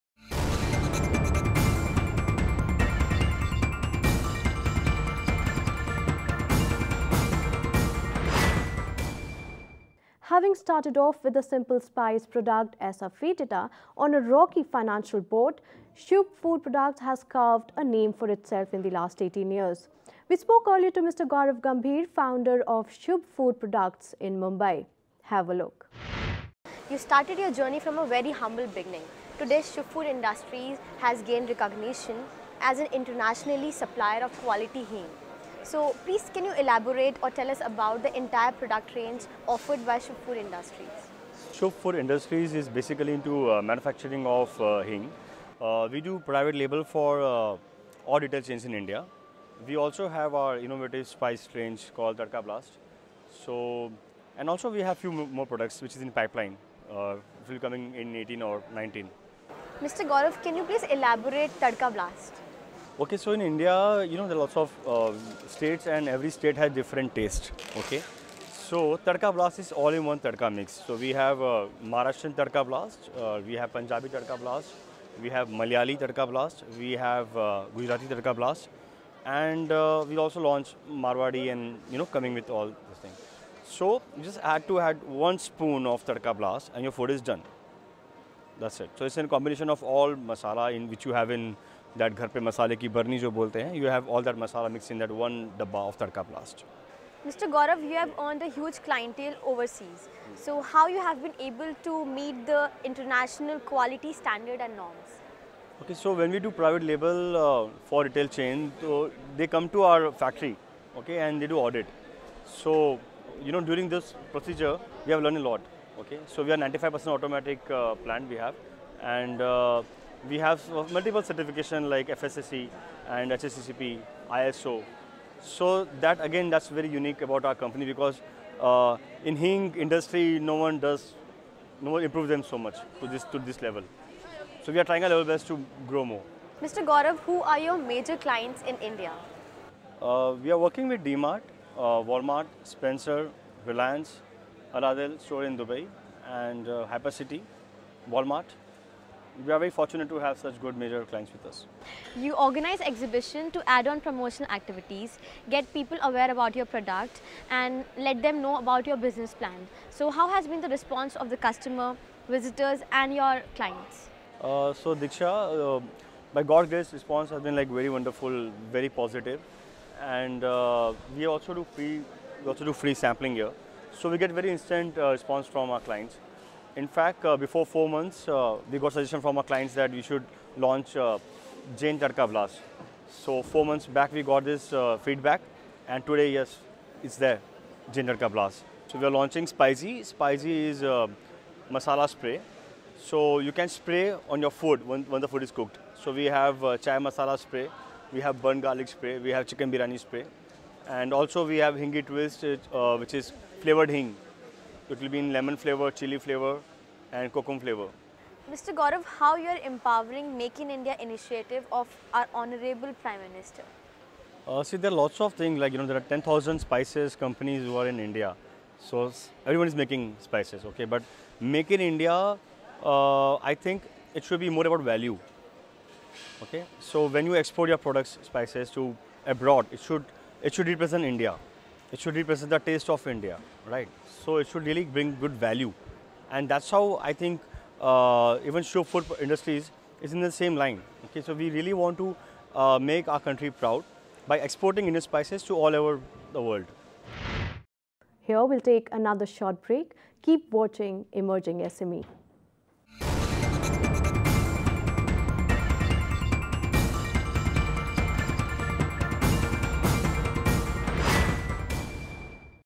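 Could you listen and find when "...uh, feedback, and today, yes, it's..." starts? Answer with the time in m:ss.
3:04.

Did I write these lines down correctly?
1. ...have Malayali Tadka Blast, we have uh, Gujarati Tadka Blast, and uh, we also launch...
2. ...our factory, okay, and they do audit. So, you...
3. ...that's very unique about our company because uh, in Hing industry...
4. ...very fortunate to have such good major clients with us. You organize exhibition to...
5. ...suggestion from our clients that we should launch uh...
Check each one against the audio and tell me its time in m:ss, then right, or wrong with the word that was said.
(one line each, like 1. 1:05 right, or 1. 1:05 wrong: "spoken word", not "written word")
1. 1:15 right
2. 1:49 right
3. 2:06 right
4. 2:29 right
5. 2:58 right.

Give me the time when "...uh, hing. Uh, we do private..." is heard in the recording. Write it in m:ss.
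0:44.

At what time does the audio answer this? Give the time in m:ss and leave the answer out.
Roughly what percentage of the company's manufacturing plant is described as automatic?
1:56.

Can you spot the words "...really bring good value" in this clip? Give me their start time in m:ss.
3:54.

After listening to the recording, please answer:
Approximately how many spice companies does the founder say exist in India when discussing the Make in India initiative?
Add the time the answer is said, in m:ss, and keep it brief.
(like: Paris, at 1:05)
10,000, at 3:36.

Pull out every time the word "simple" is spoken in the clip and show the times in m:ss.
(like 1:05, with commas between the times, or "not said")
0:11.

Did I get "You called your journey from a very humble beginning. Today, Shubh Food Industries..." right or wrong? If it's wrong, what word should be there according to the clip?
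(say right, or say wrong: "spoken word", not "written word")
wrong: "started", not "called".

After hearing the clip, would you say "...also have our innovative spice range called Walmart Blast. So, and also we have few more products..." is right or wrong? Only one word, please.
wrong.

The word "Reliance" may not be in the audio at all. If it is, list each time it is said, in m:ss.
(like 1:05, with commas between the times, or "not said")
2:23.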